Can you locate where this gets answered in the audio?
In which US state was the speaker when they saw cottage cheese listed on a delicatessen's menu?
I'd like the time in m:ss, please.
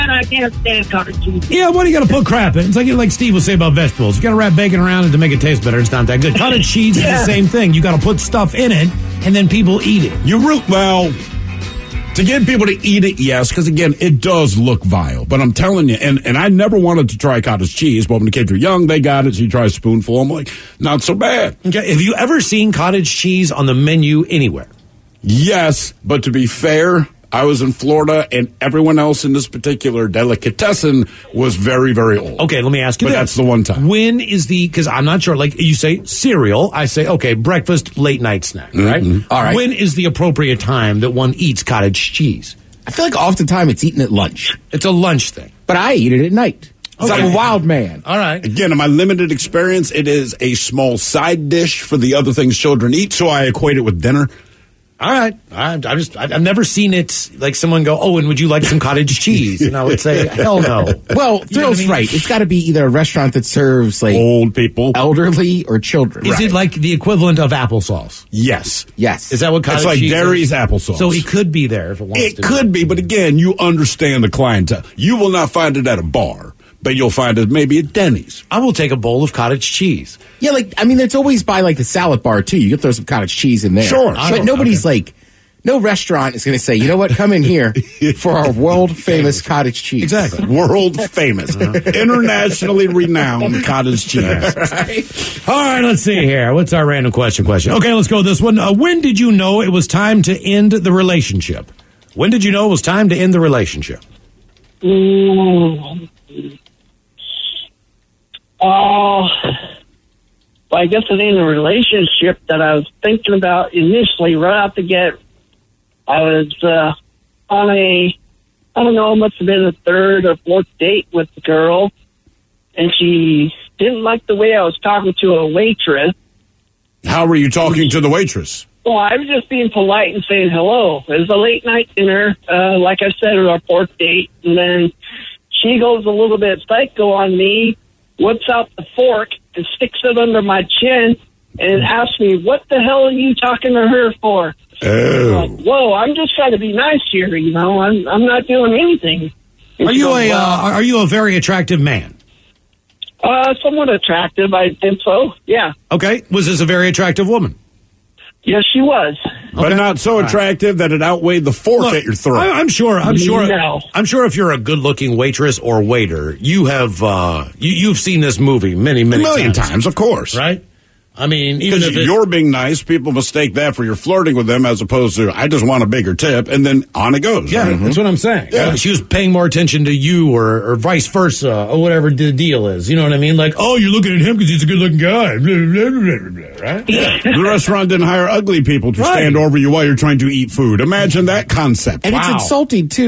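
0:27.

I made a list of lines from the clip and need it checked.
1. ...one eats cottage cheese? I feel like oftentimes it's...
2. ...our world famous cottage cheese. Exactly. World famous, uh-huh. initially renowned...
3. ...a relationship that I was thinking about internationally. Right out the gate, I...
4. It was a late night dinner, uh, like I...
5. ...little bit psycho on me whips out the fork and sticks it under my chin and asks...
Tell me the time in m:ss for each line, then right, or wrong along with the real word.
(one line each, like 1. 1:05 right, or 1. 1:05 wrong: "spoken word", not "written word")
1. 0:41 right
2. 1:28 wrong: "internationally", not "initially"
3. 1:51 wrong: "initially", not "internationally"
4. 2:11 right
5. 2:16 right.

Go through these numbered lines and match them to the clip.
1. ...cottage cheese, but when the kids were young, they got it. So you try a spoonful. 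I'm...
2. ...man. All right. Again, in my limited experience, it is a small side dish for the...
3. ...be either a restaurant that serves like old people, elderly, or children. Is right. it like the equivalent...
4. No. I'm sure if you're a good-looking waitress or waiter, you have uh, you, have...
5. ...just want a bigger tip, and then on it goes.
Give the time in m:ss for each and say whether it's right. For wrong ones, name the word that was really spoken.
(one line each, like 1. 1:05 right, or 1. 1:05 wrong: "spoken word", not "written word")
1. 0:17 right
2. 0:47 right
3. 1:02 right
4. 2:43 right
5. 2:55 right.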